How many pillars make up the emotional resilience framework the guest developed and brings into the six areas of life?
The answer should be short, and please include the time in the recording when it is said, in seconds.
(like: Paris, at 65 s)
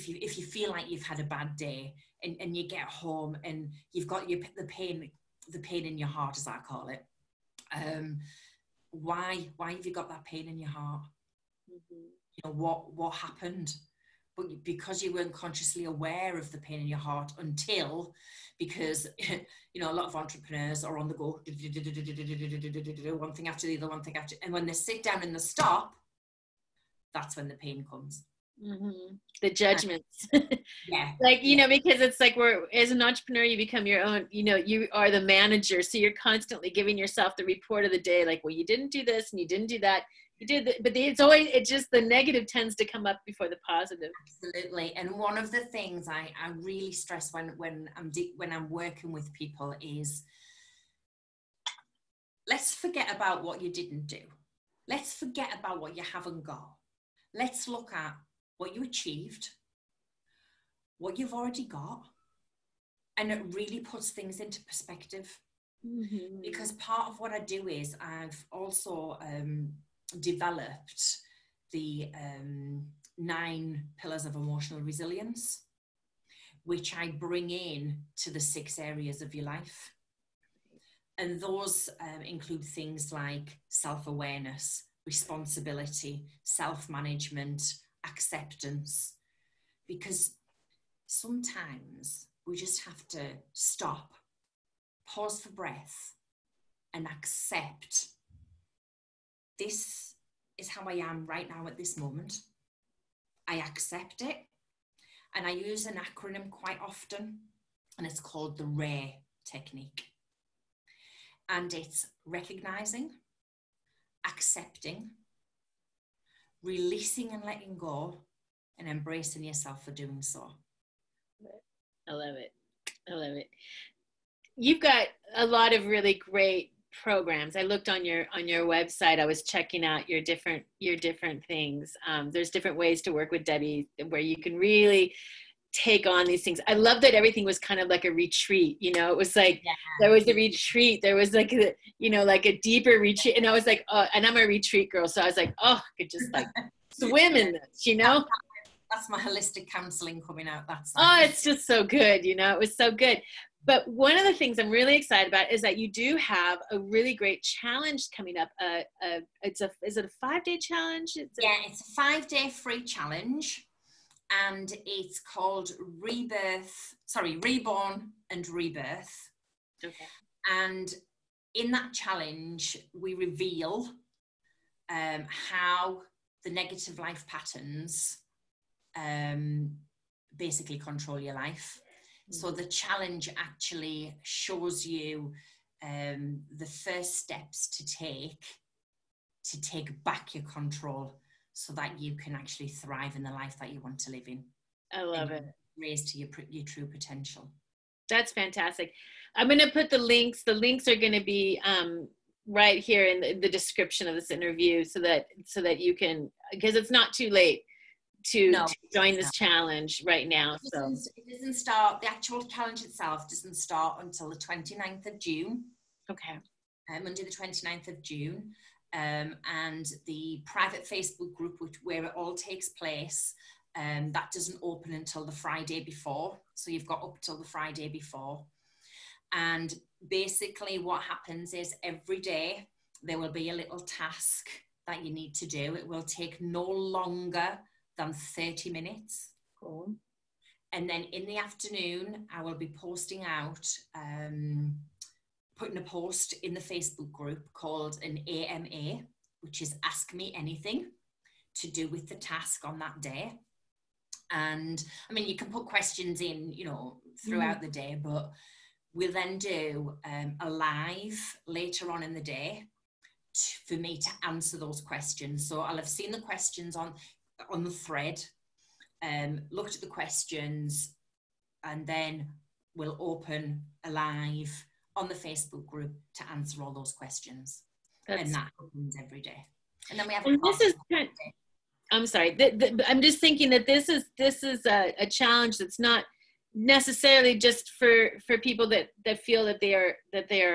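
9, at 73 s.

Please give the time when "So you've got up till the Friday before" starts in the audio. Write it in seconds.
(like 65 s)
226 s.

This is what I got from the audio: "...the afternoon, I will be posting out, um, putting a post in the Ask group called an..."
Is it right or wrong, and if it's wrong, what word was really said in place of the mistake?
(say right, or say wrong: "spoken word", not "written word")
wrong: "Facebook", not "Ask".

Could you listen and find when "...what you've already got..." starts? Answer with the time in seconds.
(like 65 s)
60 s.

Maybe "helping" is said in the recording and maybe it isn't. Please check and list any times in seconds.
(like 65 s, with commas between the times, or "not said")
not said.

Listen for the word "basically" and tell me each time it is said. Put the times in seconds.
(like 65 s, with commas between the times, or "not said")
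180 s, 230 s.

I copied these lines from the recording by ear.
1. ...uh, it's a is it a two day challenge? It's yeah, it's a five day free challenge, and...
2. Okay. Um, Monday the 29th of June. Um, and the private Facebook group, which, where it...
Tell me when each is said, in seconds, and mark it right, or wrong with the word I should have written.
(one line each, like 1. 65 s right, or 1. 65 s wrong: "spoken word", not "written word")
1. 159 s wrong: "five", not "two"
2. 216 s right.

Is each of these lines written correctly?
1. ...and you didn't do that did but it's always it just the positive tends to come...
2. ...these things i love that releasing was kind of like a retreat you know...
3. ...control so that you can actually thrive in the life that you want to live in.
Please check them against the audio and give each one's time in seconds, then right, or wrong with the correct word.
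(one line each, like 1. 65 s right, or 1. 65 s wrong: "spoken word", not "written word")
1. 39 s wrong: "negative", not "positive"
2. 136 s wrong: "everything", not "releasing"
3. 190 s right.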